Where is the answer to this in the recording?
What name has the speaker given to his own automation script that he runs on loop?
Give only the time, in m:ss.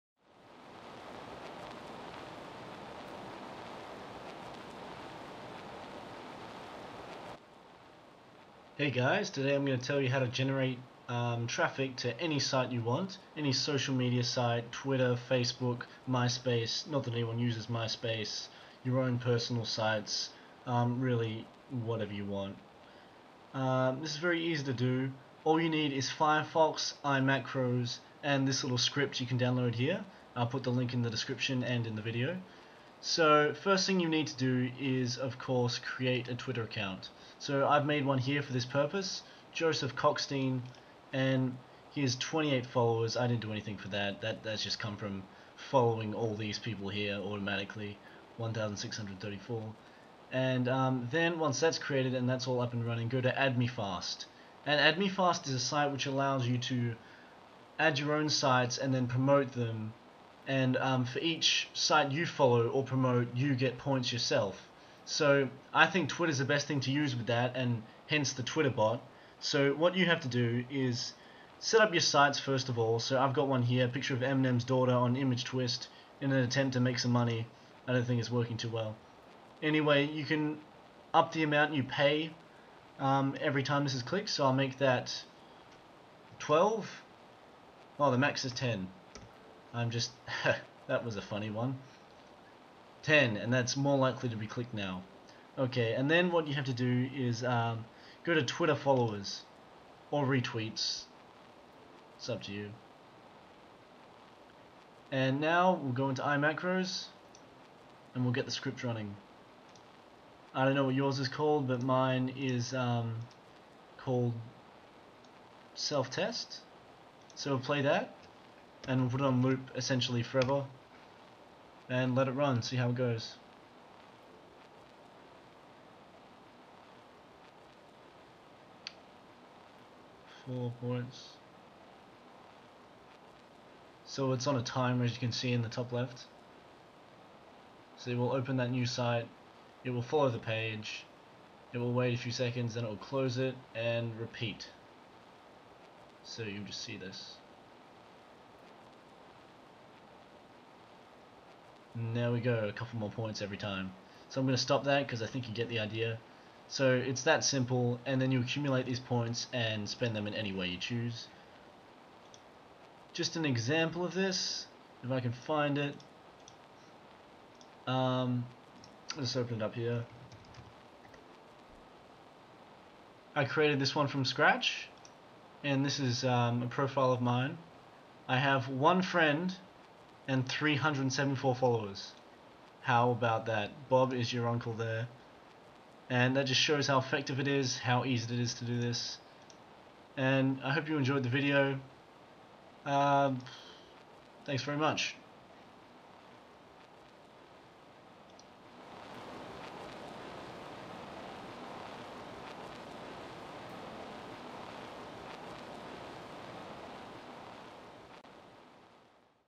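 1:55.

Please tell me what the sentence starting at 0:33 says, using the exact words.
So first thing you need to do is, of course, create a Twitter account.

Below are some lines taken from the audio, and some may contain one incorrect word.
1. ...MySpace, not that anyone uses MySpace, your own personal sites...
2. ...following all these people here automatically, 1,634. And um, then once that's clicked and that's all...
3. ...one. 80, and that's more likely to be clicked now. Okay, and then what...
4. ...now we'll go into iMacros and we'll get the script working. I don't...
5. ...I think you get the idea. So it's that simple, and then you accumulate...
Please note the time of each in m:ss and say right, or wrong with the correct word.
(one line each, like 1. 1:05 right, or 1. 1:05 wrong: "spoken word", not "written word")
1. 0:16 right
2. 0:45 wrong: "created", not "clicked"
3. 1:31 wrong: "10", not "80"
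4. 1:45 wrong: "running", not "working"
5. 2:35 right.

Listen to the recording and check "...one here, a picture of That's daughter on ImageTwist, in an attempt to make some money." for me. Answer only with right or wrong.
wrong.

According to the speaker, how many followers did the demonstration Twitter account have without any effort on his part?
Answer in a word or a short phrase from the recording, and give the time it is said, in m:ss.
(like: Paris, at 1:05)
28, at 0:42.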